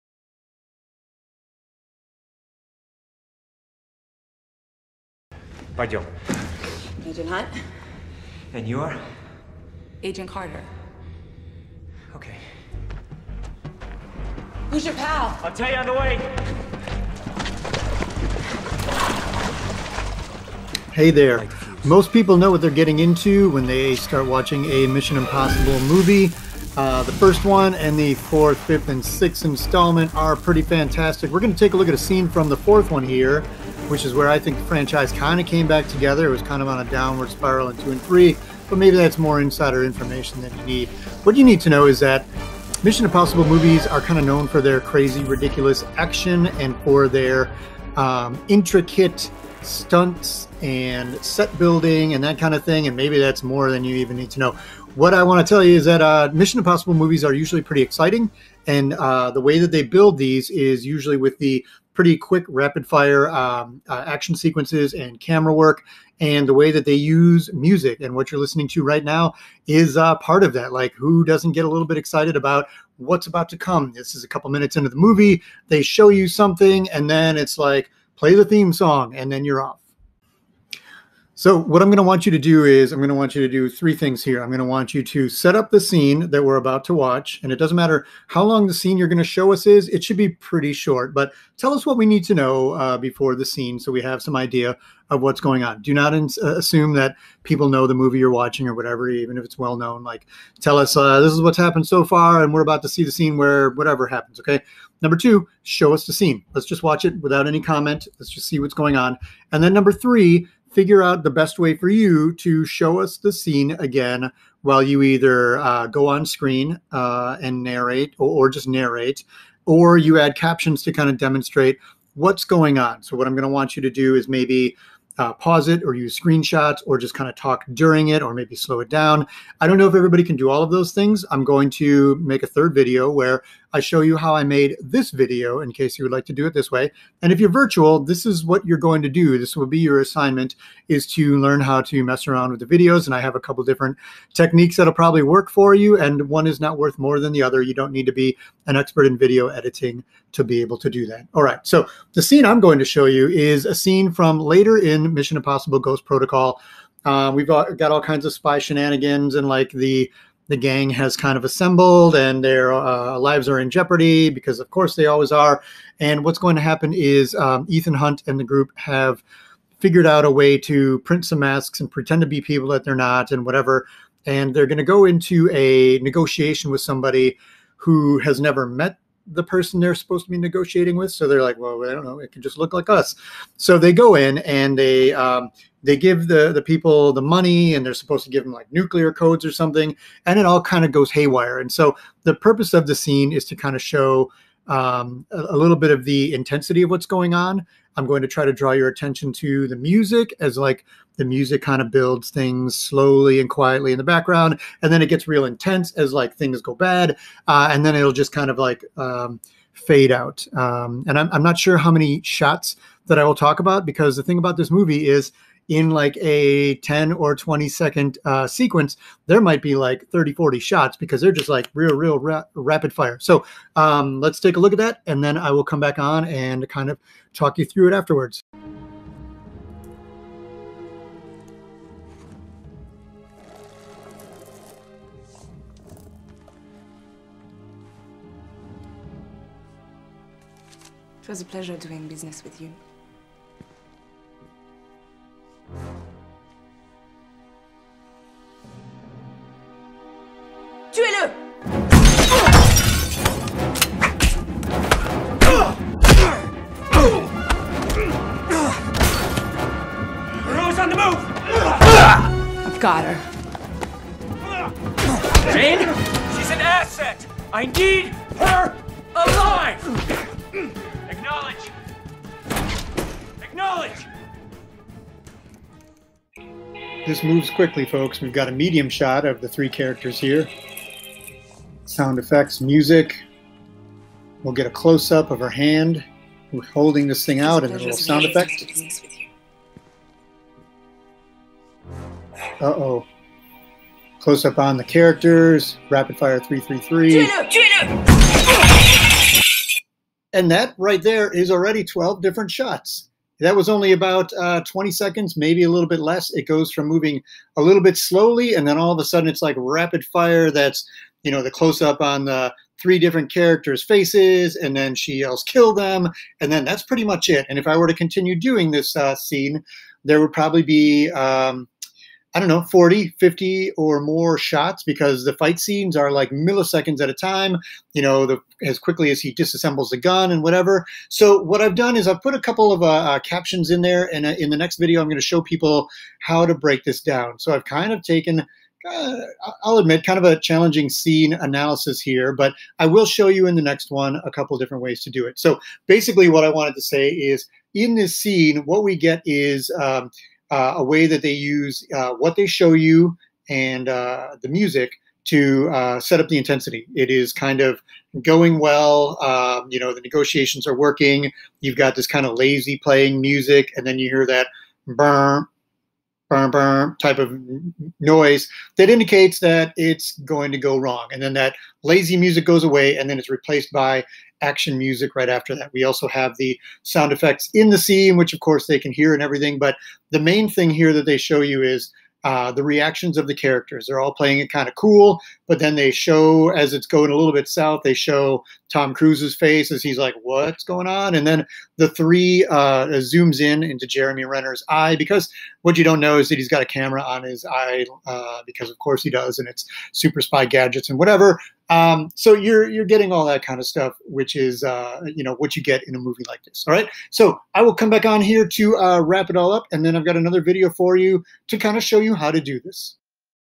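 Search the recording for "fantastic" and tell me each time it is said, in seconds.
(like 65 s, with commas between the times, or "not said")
30 s.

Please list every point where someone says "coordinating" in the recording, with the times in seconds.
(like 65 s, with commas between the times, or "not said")
not said.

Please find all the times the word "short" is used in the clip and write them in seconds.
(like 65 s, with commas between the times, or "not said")
90 s.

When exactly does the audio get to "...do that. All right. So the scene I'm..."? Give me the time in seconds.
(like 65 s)
150 s.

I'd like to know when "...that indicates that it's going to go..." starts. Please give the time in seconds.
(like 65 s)
368 s.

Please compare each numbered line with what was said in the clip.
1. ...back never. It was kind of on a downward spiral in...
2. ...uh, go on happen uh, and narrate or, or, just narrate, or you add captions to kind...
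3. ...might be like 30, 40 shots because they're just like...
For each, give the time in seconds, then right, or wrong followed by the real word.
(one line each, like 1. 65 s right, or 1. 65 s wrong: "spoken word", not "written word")
1. 35 s wrong: "together", not "never"
2. 115 s wrong: "screen", not "happen"
3. 219 s right.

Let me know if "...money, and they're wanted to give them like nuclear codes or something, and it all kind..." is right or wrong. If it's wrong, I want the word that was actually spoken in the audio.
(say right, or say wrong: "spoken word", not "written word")
wrong: "supposed", not "wanted".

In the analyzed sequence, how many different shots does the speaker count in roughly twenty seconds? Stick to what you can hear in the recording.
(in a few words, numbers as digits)
12.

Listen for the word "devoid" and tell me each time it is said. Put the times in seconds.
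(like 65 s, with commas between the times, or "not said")
not said.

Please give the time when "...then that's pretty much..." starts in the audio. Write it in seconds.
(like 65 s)
316 s.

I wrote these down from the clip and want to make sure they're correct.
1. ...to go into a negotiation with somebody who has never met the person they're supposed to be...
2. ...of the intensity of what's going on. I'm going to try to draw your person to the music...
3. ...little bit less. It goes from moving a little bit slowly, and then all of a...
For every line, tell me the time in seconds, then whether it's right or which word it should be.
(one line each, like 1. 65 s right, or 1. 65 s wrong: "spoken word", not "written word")
1. 174 s right
2. 195 s wrong: "attention", not "person"
3. 305 s right.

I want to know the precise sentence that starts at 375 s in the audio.
We also have the sound effects in the scene, which of course they can hear and everything.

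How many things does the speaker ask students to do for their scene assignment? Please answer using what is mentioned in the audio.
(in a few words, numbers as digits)
3.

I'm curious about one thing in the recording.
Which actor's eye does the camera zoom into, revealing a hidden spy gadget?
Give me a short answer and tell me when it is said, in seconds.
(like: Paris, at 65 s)
Jeremy Renner, at 393 s.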